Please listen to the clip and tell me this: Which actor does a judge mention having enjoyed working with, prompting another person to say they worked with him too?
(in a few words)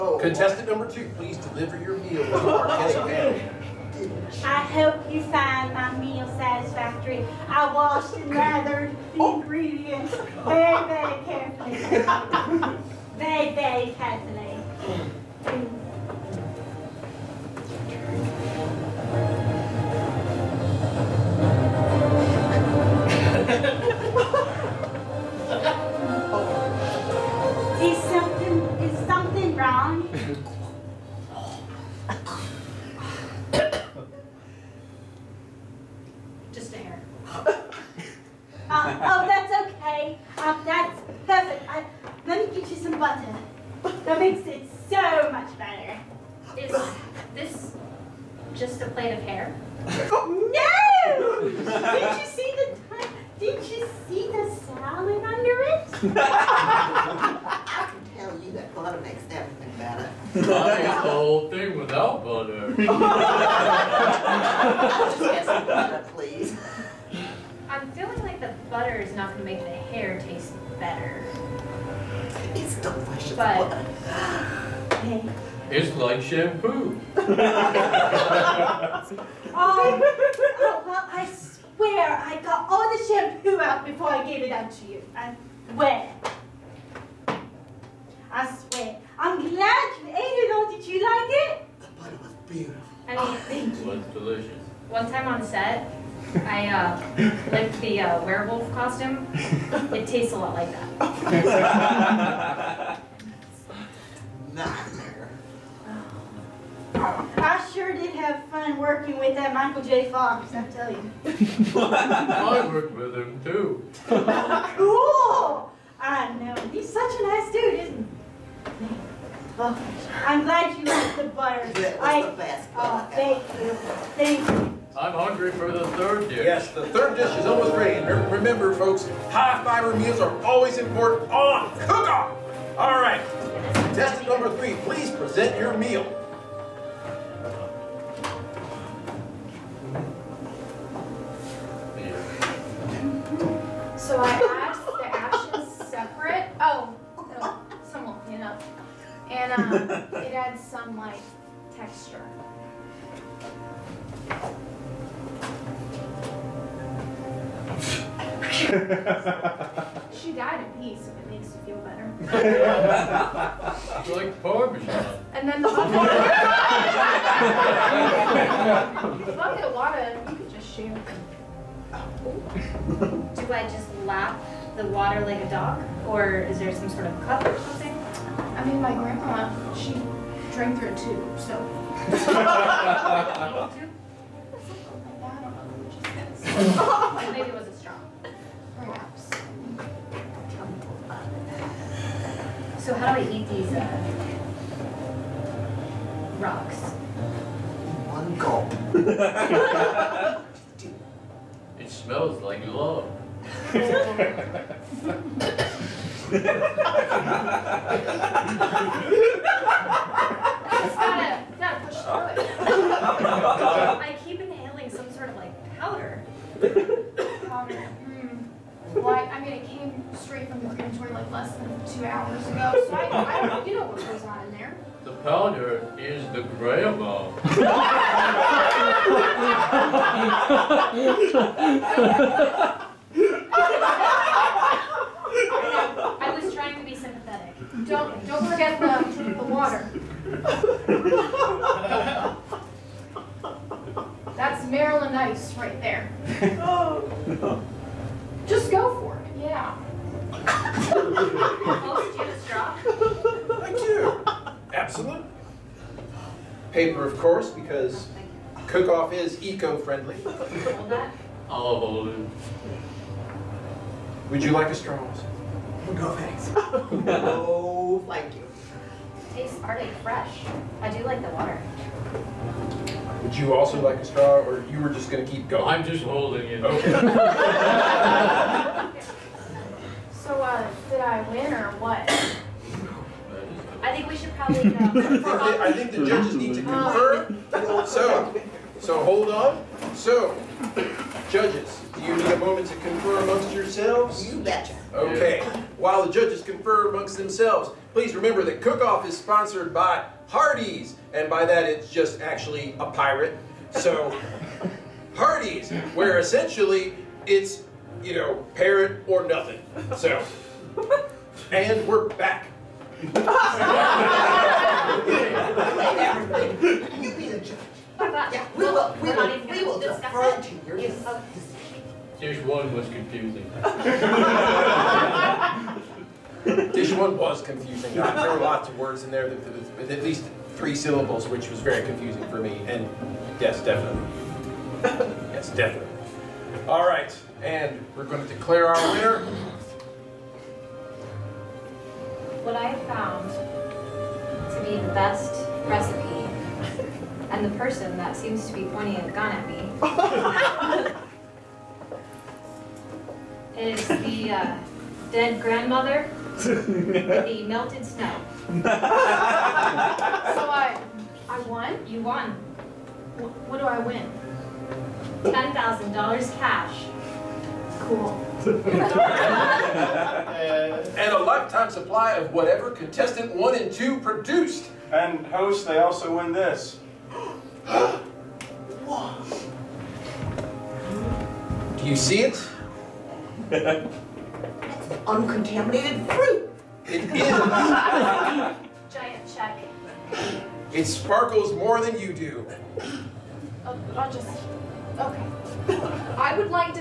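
Michael J. Fox.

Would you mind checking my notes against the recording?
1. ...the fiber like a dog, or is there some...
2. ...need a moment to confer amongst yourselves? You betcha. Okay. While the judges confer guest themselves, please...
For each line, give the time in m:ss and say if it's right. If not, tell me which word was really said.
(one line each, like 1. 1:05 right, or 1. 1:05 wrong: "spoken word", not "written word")
1. 2:54 wrong: "water", not "fiber"
2. 4:52 wrong: "amongst", not "guest".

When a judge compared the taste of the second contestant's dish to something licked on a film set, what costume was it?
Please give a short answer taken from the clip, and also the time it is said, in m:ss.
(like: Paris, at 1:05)
werewolf costume, at 1:38.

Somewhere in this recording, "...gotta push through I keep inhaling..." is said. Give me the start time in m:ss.
3:31.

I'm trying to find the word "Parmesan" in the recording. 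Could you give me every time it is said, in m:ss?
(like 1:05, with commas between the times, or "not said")
2:44.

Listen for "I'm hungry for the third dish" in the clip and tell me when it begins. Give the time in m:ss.
2:04.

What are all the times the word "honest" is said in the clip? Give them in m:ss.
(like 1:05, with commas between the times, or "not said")
not said.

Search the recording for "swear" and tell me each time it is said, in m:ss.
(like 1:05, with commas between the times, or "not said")
1:21, 1:28.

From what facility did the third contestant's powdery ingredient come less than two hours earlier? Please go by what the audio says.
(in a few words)
the crematory.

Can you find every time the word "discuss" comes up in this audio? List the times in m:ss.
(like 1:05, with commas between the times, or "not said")
5:19.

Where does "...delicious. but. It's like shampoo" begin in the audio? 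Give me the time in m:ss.
1:12.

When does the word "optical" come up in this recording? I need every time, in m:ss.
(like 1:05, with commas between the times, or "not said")
not said.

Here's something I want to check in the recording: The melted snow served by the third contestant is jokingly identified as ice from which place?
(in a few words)
Maryland.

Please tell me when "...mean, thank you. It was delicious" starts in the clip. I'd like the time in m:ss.
1:33.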